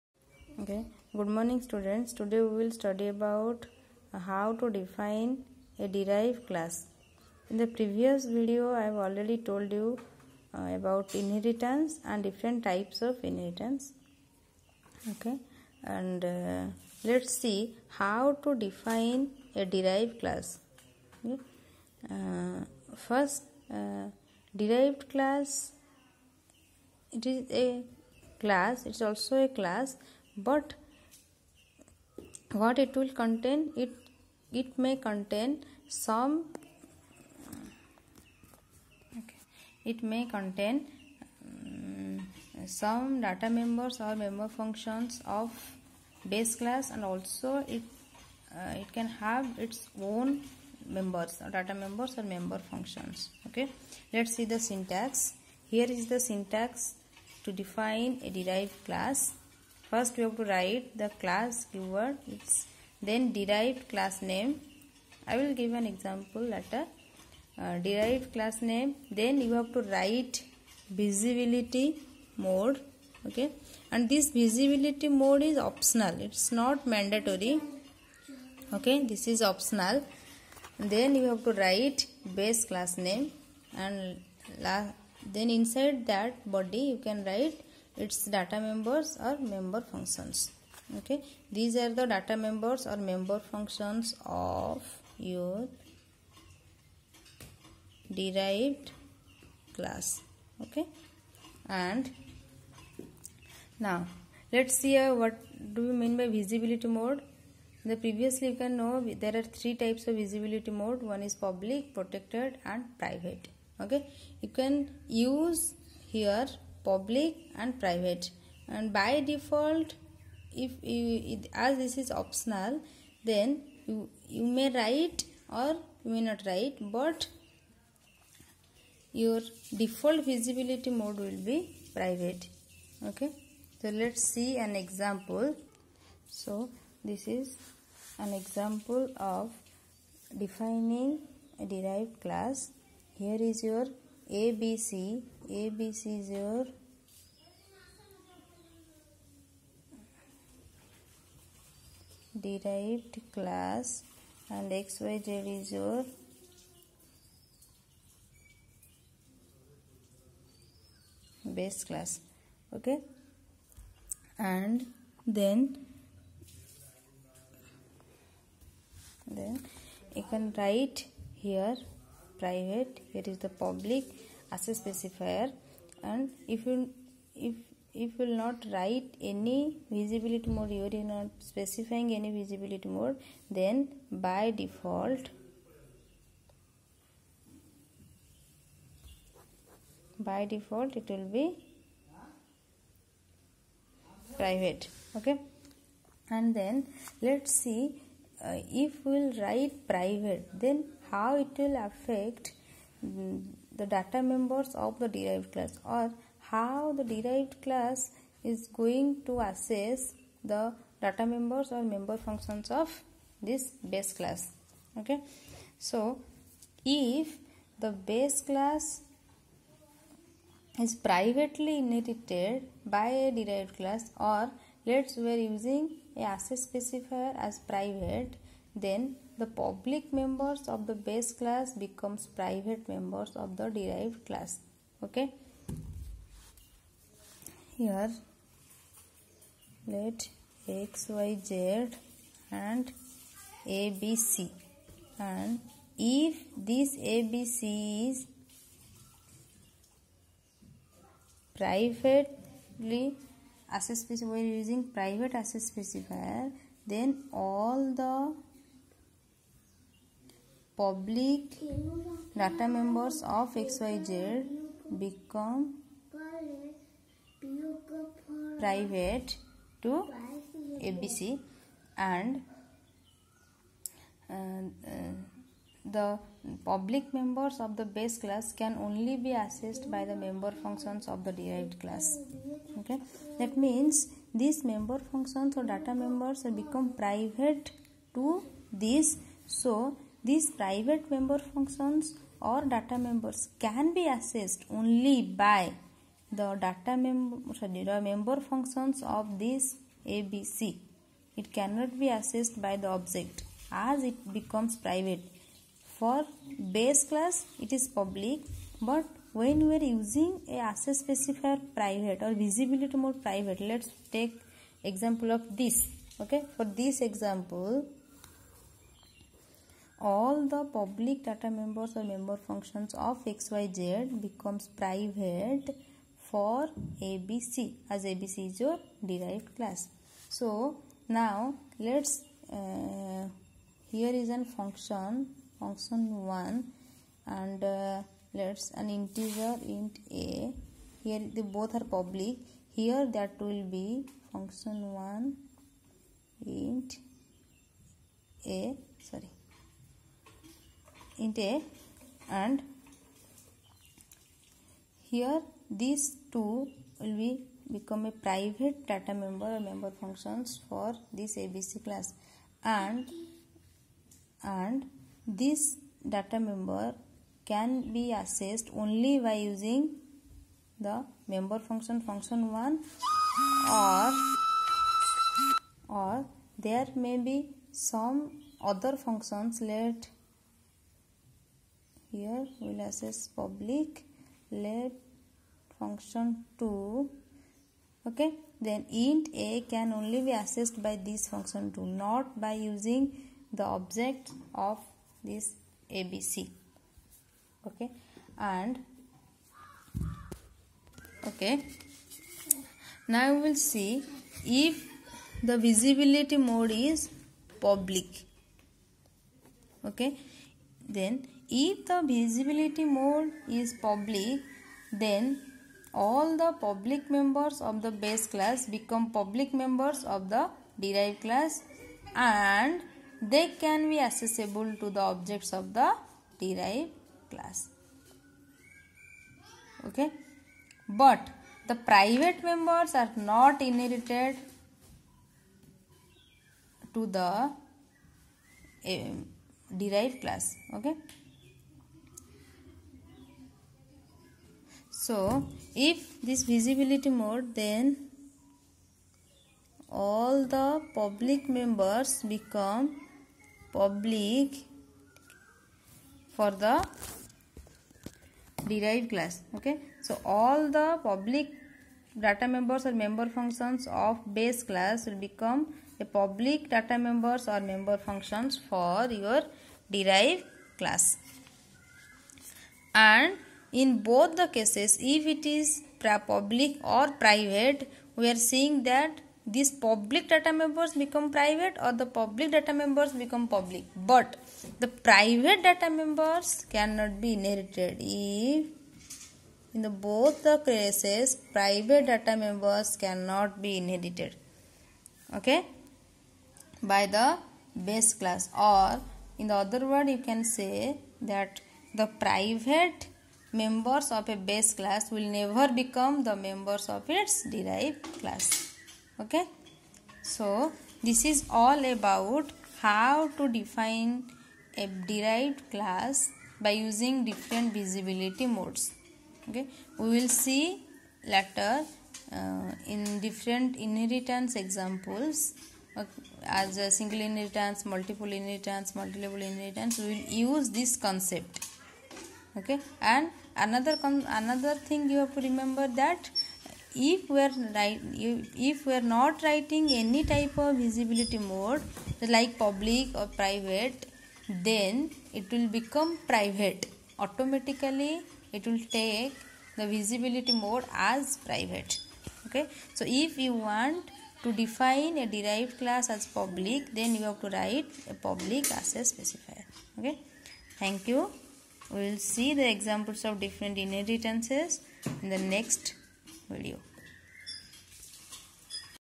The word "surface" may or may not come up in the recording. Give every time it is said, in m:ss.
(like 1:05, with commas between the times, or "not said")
not said.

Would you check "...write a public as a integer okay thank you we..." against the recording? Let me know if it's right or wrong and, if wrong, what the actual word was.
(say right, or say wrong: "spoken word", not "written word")
wrong: "specifier", not "integer".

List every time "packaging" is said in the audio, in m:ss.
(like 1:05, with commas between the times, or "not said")
not said.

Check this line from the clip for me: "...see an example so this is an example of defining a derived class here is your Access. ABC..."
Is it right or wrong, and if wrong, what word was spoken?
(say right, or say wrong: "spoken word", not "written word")
wrong: "ABC", not "Access".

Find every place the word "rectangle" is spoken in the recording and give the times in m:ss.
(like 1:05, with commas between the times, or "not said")
not said.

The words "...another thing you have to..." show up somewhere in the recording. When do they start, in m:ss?
8:54.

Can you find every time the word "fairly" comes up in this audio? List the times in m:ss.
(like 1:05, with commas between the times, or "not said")
not said.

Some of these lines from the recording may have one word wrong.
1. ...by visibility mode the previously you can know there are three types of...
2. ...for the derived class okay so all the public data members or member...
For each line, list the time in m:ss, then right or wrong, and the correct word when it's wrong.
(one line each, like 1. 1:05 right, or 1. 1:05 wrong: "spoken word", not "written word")
1. 1:46 right
2. 7:36 right.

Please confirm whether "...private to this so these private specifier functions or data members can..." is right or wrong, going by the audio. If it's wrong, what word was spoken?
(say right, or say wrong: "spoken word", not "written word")
wrong: "member", not "specifier".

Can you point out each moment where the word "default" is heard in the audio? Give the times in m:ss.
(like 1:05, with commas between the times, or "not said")
1:59, 2:09, 3:04, 3:10.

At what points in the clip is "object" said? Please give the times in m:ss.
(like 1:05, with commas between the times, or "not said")
5:02, 6:33, 7:04.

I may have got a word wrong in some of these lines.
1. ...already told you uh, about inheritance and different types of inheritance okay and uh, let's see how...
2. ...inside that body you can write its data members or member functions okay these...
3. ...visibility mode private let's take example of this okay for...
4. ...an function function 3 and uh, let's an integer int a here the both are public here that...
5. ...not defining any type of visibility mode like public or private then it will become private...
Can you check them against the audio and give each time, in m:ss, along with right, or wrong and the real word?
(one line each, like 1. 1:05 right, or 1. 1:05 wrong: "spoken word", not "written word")
1. 0:09 right
2. 1:25 right
3. 5:12 right
4. 5:34 wrong: "1", not "3"
5. 8:59 wrong: "writing", not "defining".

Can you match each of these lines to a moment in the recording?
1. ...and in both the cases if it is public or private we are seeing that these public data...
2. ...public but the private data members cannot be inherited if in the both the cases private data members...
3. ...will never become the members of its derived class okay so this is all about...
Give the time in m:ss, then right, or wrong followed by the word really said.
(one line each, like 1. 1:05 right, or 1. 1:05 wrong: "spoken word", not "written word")
1. 7:52 right
2. 8:03 right
3. 8:25 right.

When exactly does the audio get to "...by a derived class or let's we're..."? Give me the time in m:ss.
3:42.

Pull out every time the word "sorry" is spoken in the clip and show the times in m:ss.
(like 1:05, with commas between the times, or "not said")
4:57, 5:49.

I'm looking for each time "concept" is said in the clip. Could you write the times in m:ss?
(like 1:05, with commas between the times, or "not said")
8:51.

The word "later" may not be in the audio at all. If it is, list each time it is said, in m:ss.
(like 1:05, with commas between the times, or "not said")
1:06, 8:41.